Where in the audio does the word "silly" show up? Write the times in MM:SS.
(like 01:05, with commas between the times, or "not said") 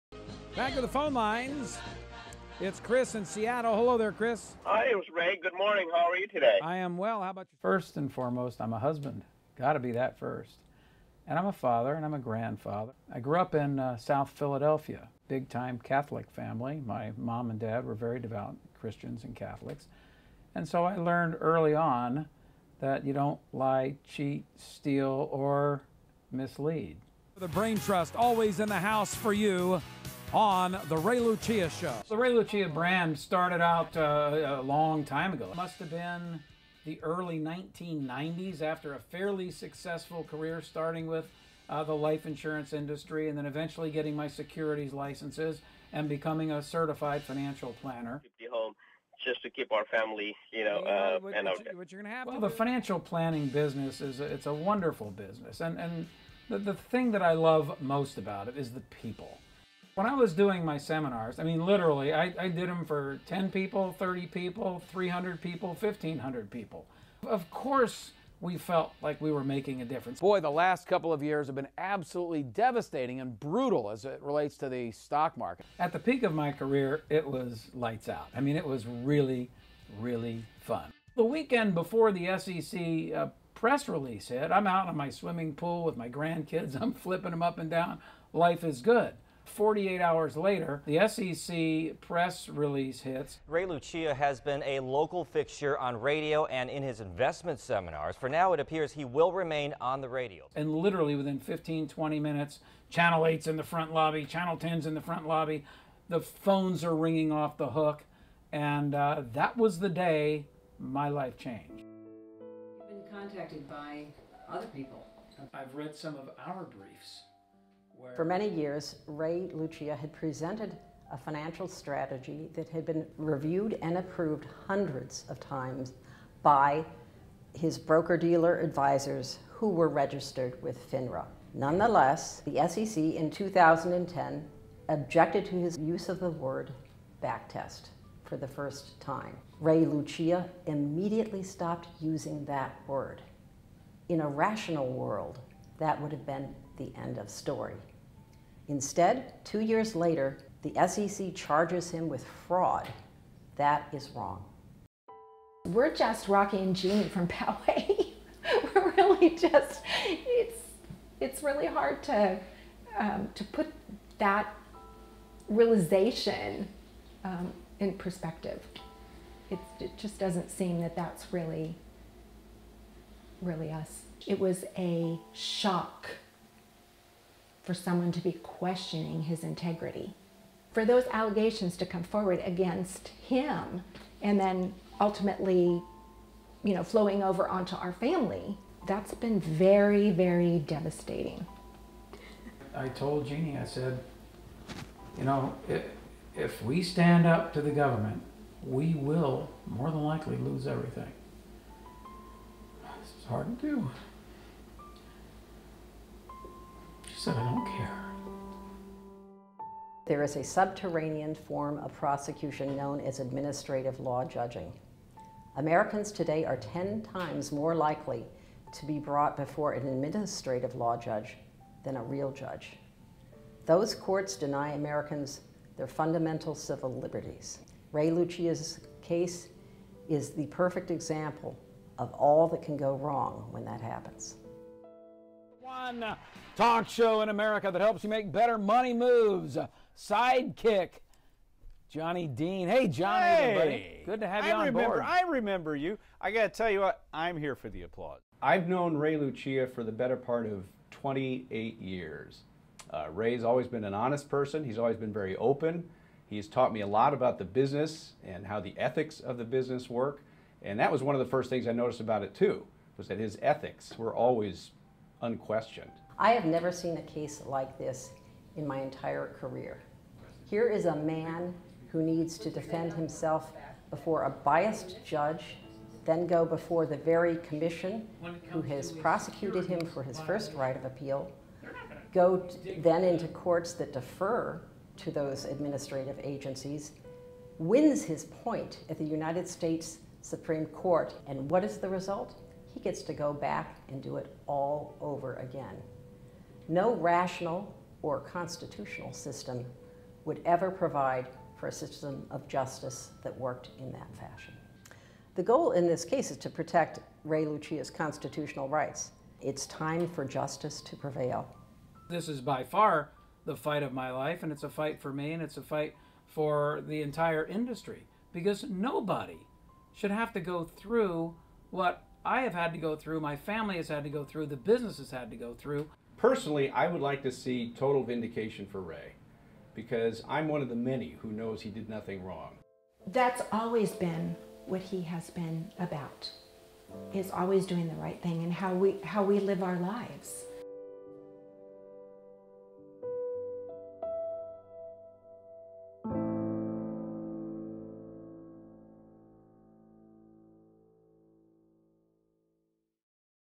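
not said.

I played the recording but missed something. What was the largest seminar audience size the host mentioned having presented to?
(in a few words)
1,500 people.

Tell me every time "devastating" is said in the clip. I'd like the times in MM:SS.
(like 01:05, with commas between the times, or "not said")
01:12, 03:10.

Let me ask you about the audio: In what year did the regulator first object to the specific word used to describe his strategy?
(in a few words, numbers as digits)
2010.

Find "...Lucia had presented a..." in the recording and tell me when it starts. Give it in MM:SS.
01:59.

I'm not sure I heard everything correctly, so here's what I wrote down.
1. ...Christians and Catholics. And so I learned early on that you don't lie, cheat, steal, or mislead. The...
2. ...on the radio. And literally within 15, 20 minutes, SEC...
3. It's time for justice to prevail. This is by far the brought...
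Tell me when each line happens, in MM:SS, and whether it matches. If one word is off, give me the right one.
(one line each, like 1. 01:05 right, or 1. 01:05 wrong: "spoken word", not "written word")
1. 00:18 right
2. 01:39 wrong: "Channel", not "SEC"
3. 05:09 wrong: "fight", not "brought".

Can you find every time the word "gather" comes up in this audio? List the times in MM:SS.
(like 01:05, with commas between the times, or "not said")
not said.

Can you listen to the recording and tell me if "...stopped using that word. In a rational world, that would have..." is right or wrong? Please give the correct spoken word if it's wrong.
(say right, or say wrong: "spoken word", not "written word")
right.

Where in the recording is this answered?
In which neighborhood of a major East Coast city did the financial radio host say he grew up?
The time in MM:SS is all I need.
00:13.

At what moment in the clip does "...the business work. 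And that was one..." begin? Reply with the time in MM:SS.
04:19.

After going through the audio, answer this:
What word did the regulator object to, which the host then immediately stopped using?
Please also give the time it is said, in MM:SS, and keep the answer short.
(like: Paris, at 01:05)
backtest, at 02:17.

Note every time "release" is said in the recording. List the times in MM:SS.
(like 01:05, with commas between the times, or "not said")
01:23, 01:32.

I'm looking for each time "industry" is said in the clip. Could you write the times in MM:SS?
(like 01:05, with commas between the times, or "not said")
00:42, 05:17.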